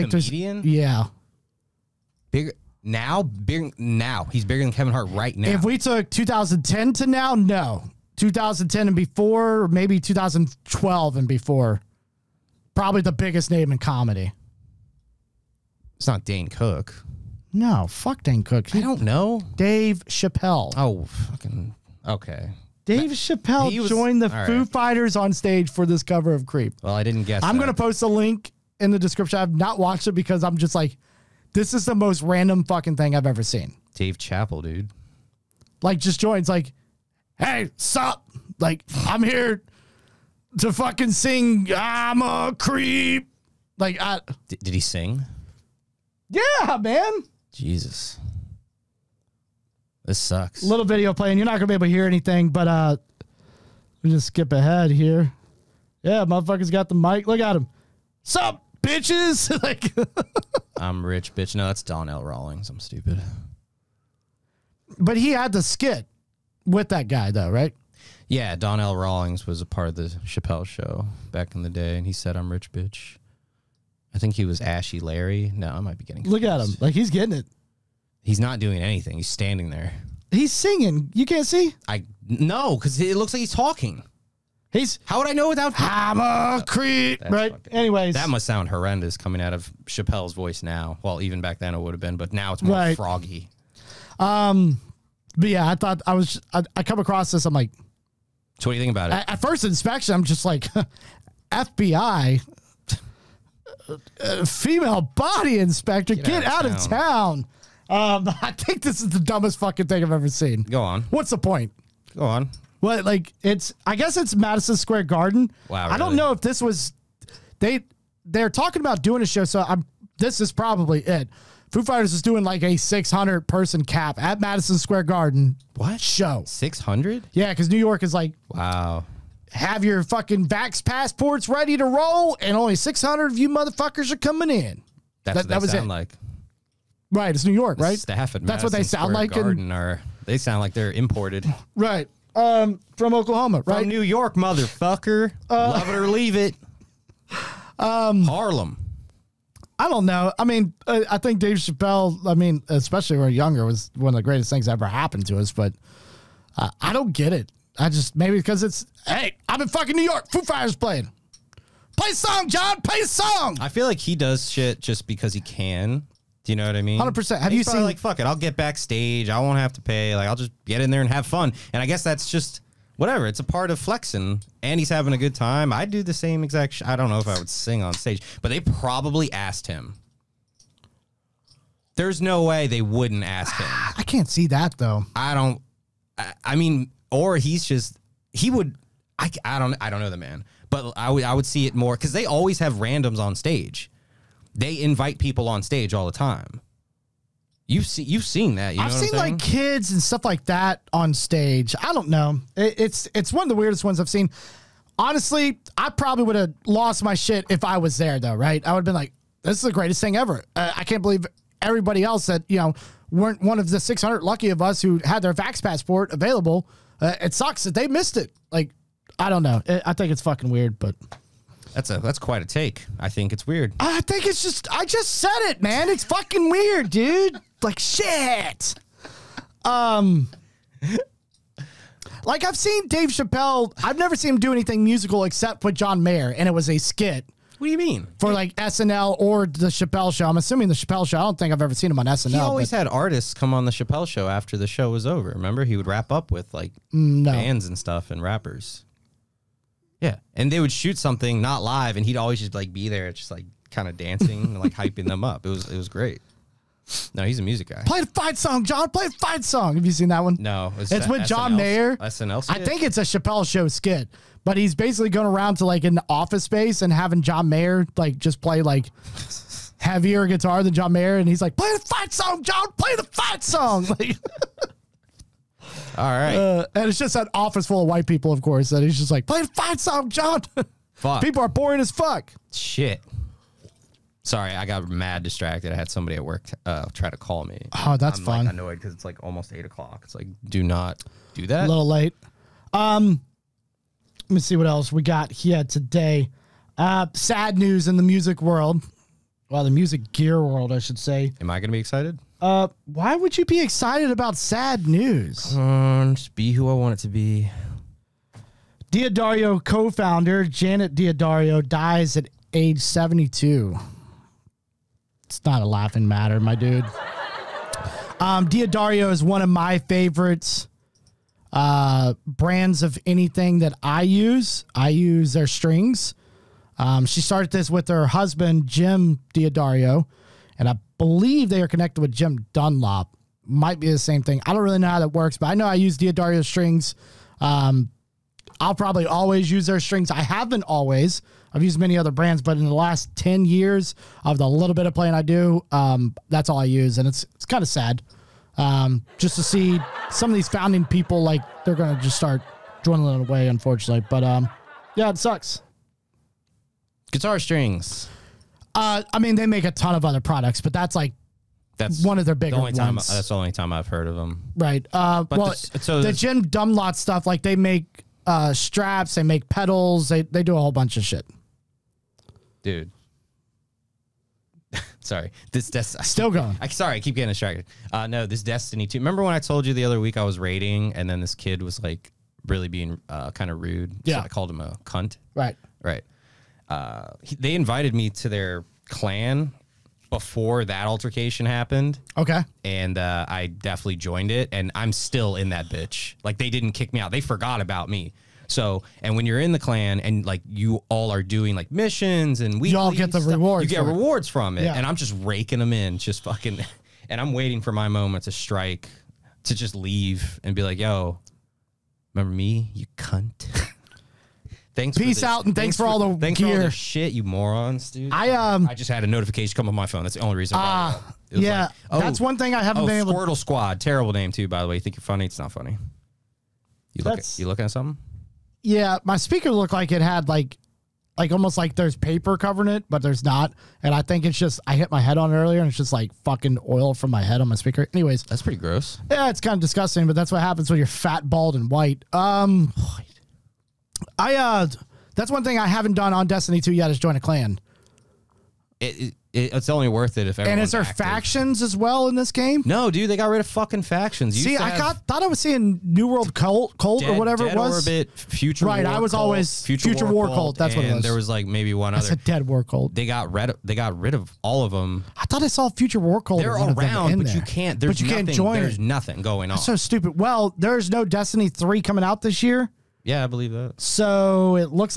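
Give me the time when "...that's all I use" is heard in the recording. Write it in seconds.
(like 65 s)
346 s.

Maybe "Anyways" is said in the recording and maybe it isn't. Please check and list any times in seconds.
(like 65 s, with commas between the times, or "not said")
87 s, 437 s.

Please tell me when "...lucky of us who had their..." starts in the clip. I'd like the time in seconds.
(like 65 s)
214 s.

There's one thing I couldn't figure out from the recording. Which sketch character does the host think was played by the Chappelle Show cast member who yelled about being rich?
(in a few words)
Ashy Larry.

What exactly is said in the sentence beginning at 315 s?
It's not a laughing matter, my dude.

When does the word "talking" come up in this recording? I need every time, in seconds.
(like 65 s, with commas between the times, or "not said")
83 s, 118 s.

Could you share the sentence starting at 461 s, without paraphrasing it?
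There was like maybe one That's other.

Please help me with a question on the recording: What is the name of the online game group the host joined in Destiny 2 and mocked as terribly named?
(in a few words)
Squirtle Squad.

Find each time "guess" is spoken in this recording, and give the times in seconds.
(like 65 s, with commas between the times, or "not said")
27 s, 113 s, 171 s.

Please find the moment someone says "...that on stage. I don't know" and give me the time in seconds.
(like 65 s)
200 s.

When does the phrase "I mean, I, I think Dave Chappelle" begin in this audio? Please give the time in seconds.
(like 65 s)
150 s.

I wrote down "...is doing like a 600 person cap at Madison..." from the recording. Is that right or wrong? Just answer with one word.
right.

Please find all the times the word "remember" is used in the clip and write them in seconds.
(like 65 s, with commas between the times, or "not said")
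245 s, 378 s, 412 s.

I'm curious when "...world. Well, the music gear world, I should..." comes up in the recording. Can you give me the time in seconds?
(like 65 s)
298 s.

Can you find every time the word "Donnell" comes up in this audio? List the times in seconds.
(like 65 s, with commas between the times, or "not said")
61 s, 68 s.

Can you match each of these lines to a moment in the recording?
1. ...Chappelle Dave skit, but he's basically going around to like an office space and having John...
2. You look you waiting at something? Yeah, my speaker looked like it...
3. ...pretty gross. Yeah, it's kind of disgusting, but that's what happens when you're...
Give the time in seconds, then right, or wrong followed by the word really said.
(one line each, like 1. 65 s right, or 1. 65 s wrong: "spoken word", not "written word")
1. 263 s wrong: "Show", not "Dave"
2. 426 s wrong: "looking", not "waiting"
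3. 438 s right.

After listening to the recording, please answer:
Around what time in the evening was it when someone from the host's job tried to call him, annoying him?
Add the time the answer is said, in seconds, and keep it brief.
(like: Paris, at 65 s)
8 o'clock, at 289 s.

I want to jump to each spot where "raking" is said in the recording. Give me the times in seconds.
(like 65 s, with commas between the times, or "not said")
405 s.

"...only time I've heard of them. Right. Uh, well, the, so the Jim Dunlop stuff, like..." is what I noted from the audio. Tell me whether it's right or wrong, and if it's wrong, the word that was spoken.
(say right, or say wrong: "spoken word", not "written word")
right.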